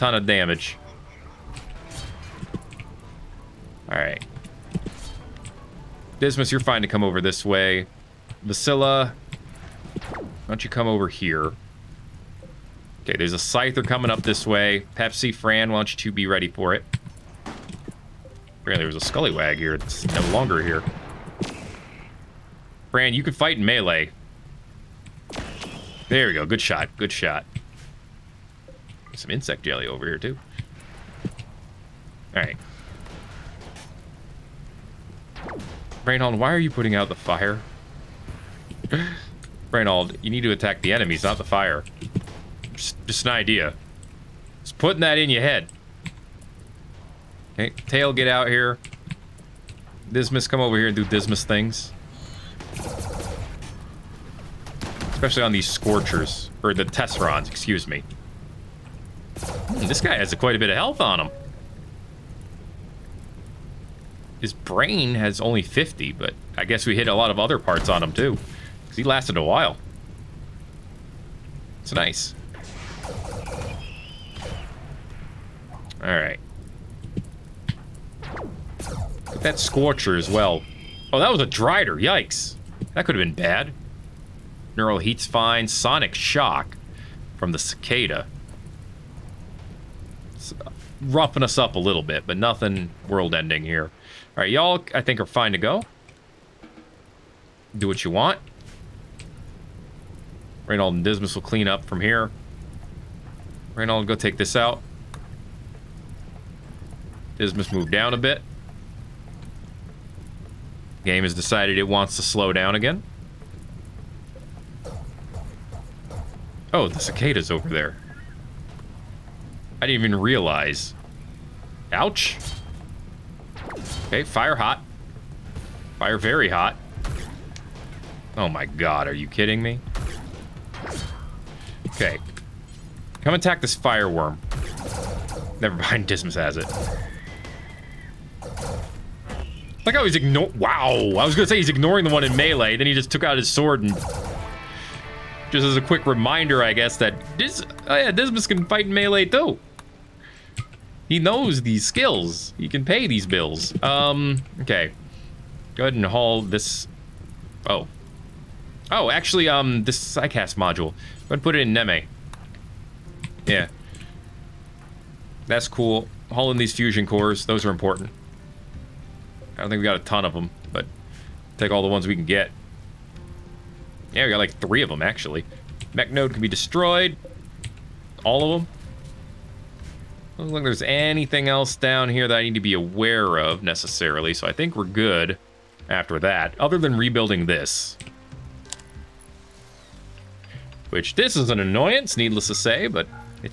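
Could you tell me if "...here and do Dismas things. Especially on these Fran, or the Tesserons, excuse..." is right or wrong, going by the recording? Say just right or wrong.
wrong.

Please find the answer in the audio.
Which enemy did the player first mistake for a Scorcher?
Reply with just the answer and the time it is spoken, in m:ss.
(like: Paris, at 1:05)
Drider, at 1:21.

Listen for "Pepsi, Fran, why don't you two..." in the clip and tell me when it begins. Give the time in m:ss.
0:14.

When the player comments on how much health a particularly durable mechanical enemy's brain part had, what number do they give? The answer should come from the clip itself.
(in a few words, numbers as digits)
50.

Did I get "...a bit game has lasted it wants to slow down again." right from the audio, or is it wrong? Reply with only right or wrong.
wrong.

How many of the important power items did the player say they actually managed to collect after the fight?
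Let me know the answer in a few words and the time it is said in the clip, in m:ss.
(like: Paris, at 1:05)
3, at 2:54.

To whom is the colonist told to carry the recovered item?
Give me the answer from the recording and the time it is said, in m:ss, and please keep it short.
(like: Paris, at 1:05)
Neme, at 2:41.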